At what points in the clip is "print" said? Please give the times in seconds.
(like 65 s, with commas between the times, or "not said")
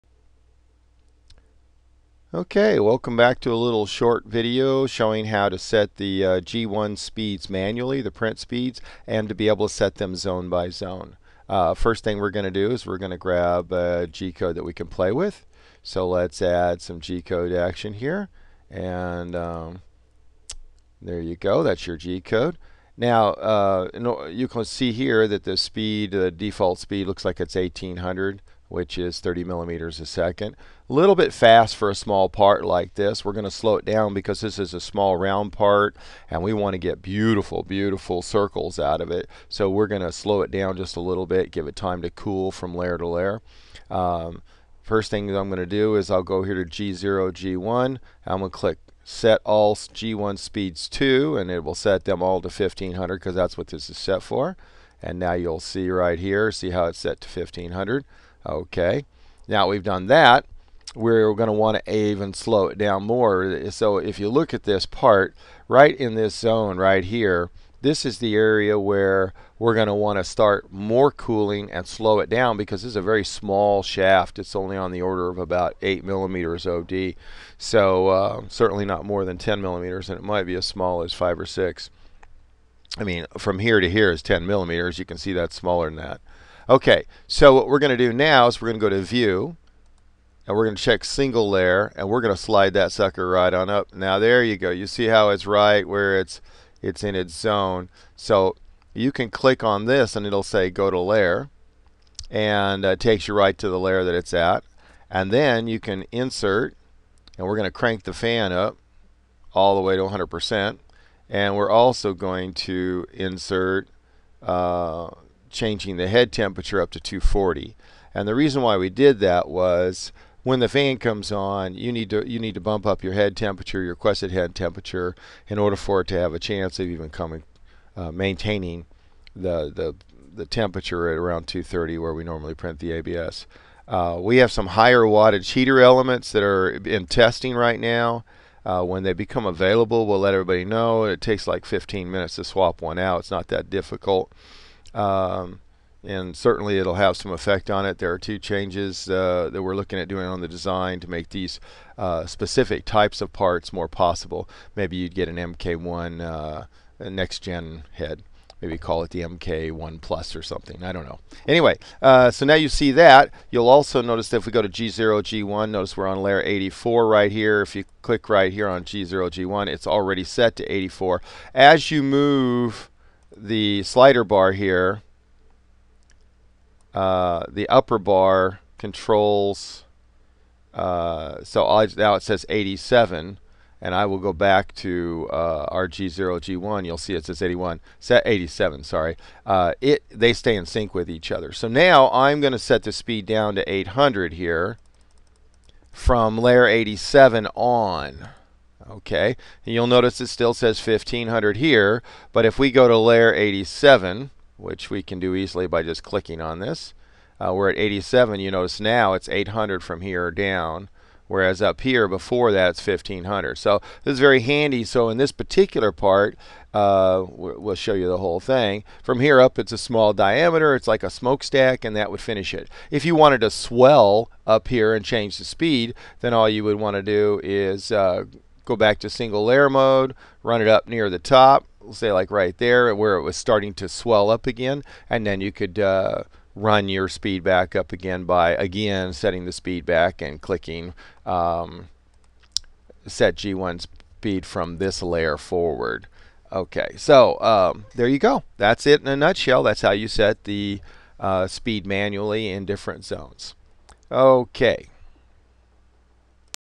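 8 s, 132 s.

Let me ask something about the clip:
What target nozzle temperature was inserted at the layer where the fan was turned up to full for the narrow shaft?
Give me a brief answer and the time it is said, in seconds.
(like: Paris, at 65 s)
240, at 116 s.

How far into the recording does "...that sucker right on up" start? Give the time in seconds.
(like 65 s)
92 s.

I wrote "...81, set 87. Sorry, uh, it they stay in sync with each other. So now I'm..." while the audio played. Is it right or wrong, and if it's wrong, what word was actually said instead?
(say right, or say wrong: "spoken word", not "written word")
right.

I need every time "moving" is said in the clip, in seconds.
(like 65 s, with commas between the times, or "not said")
not said.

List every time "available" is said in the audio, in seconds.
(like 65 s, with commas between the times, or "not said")
139 s.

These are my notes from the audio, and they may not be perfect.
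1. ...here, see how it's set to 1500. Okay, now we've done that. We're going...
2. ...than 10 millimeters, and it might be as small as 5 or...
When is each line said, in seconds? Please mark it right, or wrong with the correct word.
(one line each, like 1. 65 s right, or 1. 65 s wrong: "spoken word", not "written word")
1. 56 s right
2. 79 s right.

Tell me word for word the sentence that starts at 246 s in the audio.
Okay, so um, there you go.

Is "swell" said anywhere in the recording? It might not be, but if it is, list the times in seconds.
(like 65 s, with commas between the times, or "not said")
223 s, 233 s.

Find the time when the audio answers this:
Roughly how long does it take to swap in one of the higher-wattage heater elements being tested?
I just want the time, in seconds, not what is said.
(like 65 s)
141 s.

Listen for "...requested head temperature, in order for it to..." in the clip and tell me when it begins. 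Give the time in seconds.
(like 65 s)
123 s.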